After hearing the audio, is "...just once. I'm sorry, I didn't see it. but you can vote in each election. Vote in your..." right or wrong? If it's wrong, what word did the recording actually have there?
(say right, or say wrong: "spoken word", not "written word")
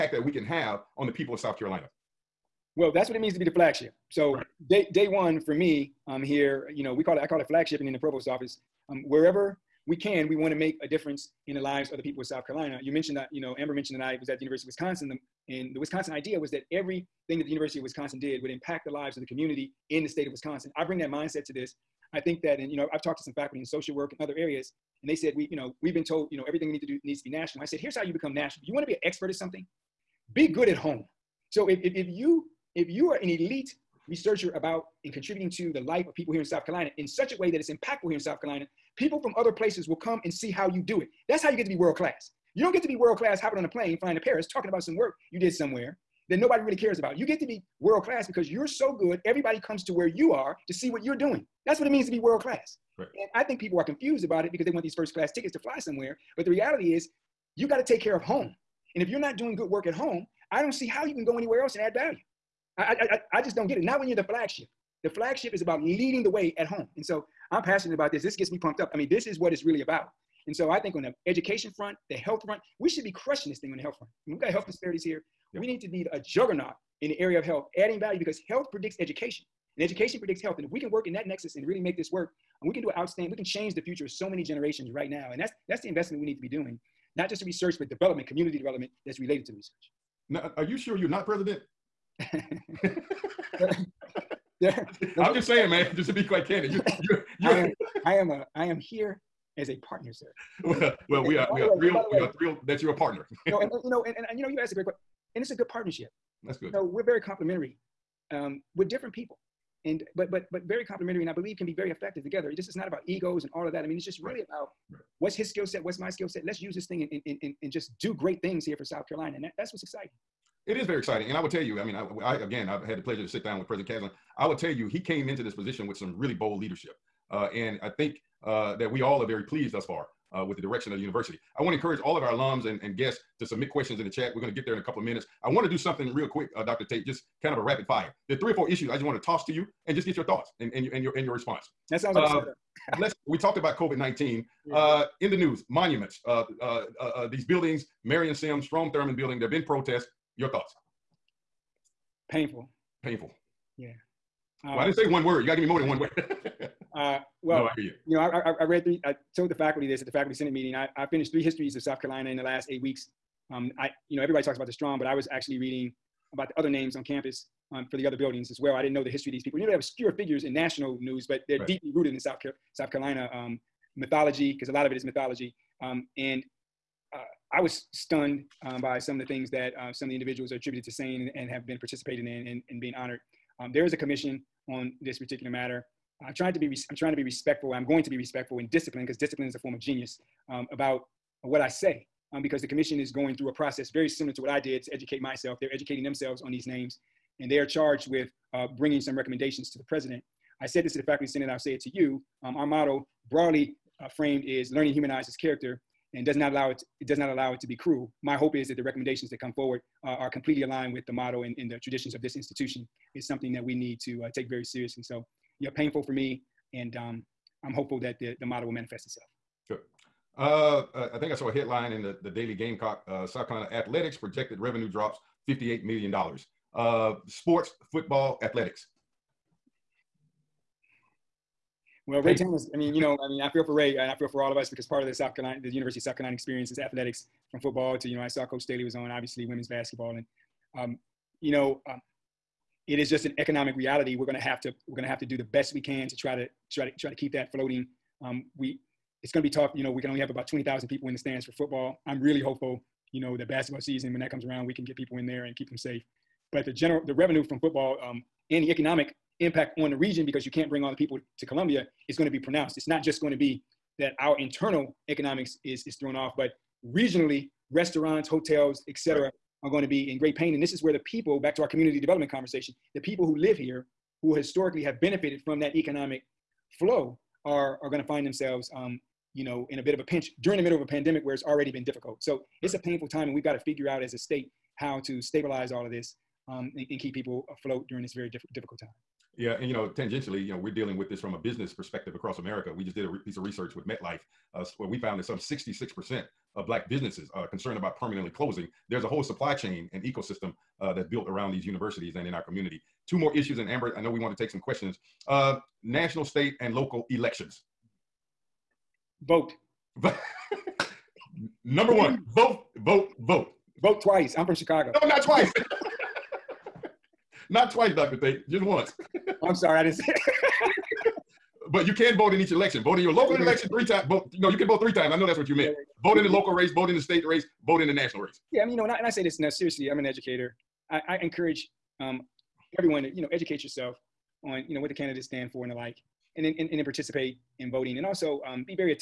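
right.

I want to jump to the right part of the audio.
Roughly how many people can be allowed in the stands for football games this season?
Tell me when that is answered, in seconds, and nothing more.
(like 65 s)
250 s.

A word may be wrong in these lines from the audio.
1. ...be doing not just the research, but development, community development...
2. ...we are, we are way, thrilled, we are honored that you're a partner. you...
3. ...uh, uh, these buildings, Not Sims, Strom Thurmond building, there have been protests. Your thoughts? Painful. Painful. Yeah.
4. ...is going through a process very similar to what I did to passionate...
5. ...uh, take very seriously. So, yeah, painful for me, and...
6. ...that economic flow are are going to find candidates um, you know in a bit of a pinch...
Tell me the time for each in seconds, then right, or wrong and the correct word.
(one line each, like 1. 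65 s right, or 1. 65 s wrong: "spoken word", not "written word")
1. 86 s right
2. 101 s wrong: "thrilled", not "honored"
3. 146 s wrong: "Marion", not "Not"
4. 192 s wrong: "educate", not "passionate"
5. 214 s right
6. 275 s wrong: "themselves", not "candidates".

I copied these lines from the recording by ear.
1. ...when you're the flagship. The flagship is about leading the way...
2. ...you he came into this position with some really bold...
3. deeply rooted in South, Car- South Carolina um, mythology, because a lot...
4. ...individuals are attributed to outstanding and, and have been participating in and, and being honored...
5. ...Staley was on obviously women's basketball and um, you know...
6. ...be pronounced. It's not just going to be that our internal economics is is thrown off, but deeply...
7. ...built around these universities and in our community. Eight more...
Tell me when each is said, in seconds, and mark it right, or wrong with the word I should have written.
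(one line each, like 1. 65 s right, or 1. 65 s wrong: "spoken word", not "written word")
1. 63 s right
2. 124 s right
3. 171 s right
4. 180 s wrong: "saying", not "outstanding"
5. 238 s right
6. 262 s wrong: "regionally", not "deeply"
7. 301 s wrong: "Two", not "Eight".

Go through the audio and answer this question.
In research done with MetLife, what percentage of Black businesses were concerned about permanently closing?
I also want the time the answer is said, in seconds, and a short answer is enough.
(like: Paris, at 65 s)
66%, at 295 s.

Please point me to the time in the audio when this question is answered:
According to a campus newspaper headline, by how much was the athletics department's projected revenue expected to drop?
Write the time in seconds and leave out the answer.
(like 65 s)
225 s.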